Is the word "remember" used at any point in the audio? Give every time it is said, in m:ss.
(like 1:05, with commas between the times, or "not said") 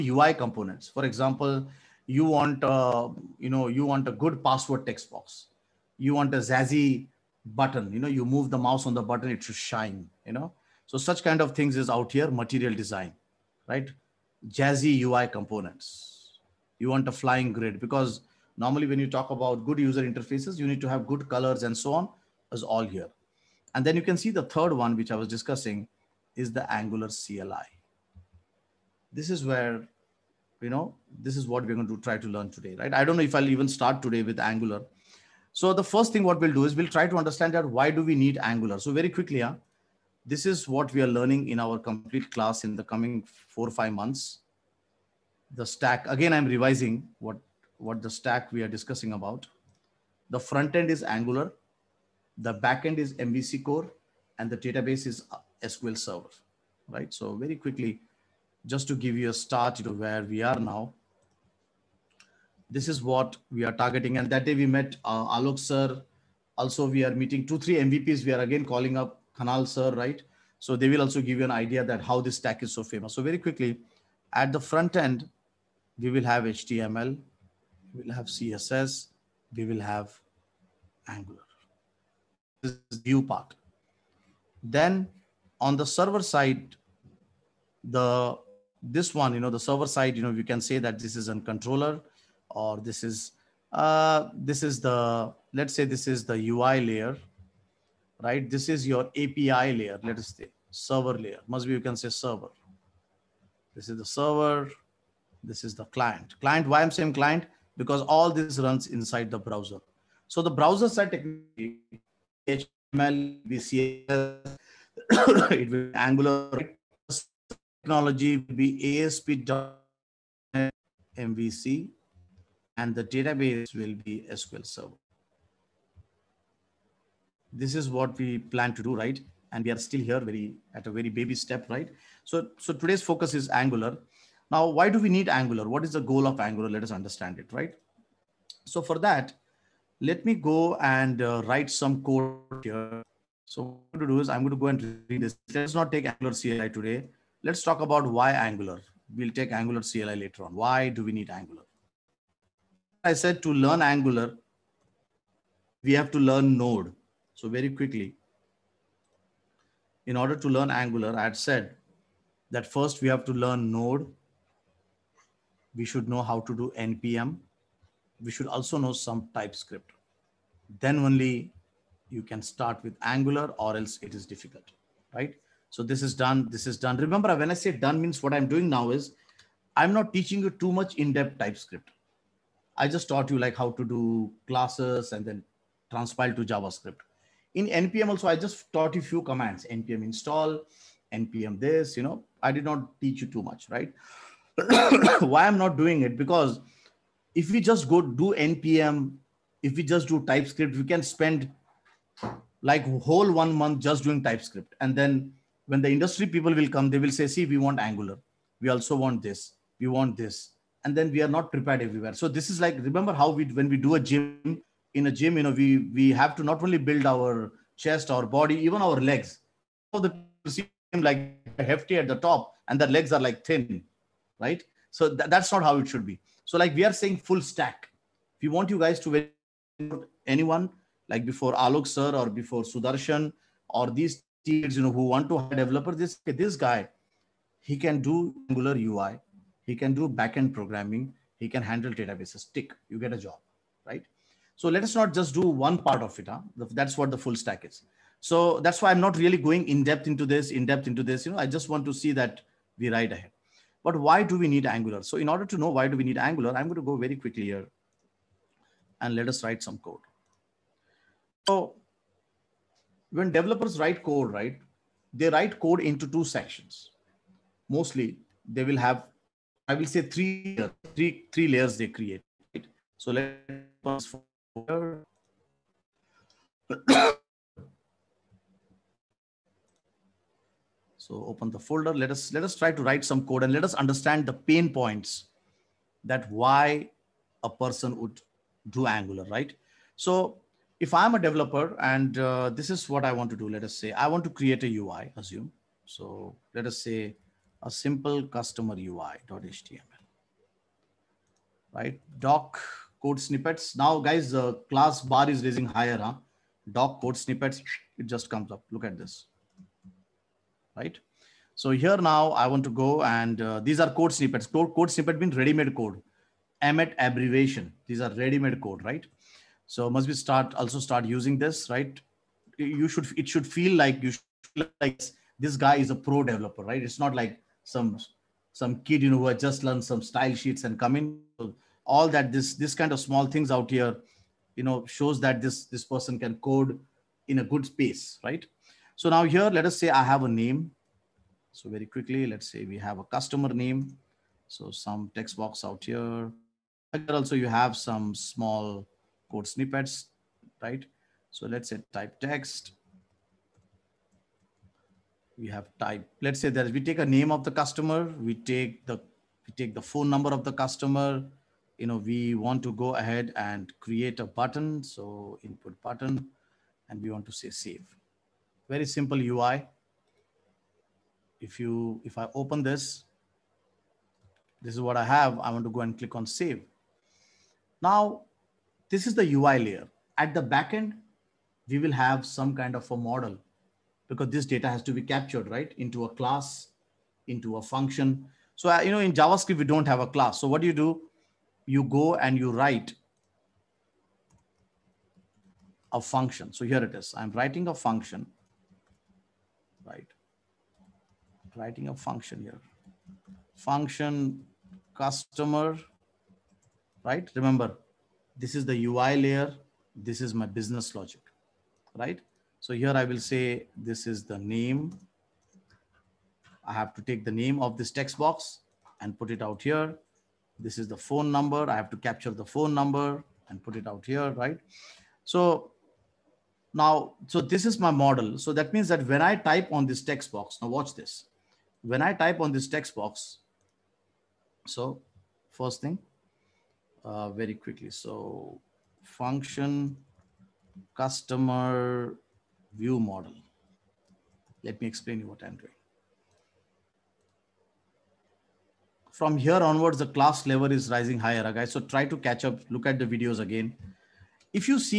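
2:56, 3:32, 6:47.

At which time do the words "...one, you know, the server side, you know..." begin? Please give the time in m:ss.
1:29.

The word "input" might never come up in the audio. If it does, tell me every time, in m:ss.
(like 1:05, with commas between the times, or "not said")
6:05.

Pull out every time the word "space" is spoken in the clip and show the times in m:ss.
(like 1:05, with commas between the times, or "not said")
5:37.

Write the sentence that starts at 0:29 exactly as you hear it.
This is where, you know, this is what we're going to try to learn today, right?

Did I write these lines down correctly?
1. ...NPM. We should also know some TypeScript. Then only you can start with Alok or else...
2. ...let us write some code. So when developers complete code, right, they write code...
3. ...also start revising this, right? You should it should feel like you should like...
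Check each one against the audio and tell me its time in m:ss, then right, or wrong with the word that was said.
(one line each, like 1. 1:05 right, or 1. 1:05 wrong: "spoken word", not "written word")
1. 2:46 wrong: "Angular", not "Alok"
2. 4:19 wrong: "write", not "complete"
3. 5:20 wrong: "using", not "revising".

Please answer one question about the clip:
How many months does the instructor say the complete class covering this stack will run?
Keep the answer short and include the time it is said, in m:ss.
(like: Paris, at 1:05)
four or five months, at 0:43.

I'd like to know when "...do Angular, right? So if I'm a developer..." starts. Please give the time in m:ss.
4:48.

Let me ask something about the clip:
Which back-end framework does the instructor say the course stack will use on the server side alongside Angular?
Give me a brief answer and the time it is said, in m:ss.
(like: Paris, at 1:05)
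MVC core, at 0:53.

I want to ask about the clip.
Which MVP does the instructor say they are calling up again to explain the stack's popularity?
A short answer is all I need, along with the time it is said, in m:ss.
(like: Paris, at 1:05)
Thanal, at 1:09.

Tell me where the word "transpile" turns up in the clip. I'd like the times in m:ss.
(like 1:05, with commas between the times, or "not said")
3:05.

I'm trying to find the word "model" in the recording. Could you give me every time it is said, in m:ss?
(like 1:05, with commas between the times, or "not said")
6:22, 7:07, 7:22.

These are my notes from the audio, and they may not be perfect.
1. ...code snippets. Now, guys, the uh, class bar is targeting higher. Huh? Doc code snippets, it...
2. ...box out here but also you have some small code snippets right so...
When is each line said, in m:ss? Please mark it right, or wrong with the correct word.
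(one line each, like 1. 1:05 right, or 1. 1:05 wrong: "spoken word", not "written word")
1. 5:03 wrong: "raising", not "targeting"
2. 5:45 right.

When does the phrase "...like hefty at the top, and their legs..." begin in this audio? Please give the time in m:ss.
3:41.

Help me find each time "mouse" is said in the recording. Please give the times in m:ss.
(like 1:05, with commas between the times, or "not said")
0:08.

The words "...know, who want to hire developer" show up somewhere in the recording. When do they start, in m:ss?
3:54.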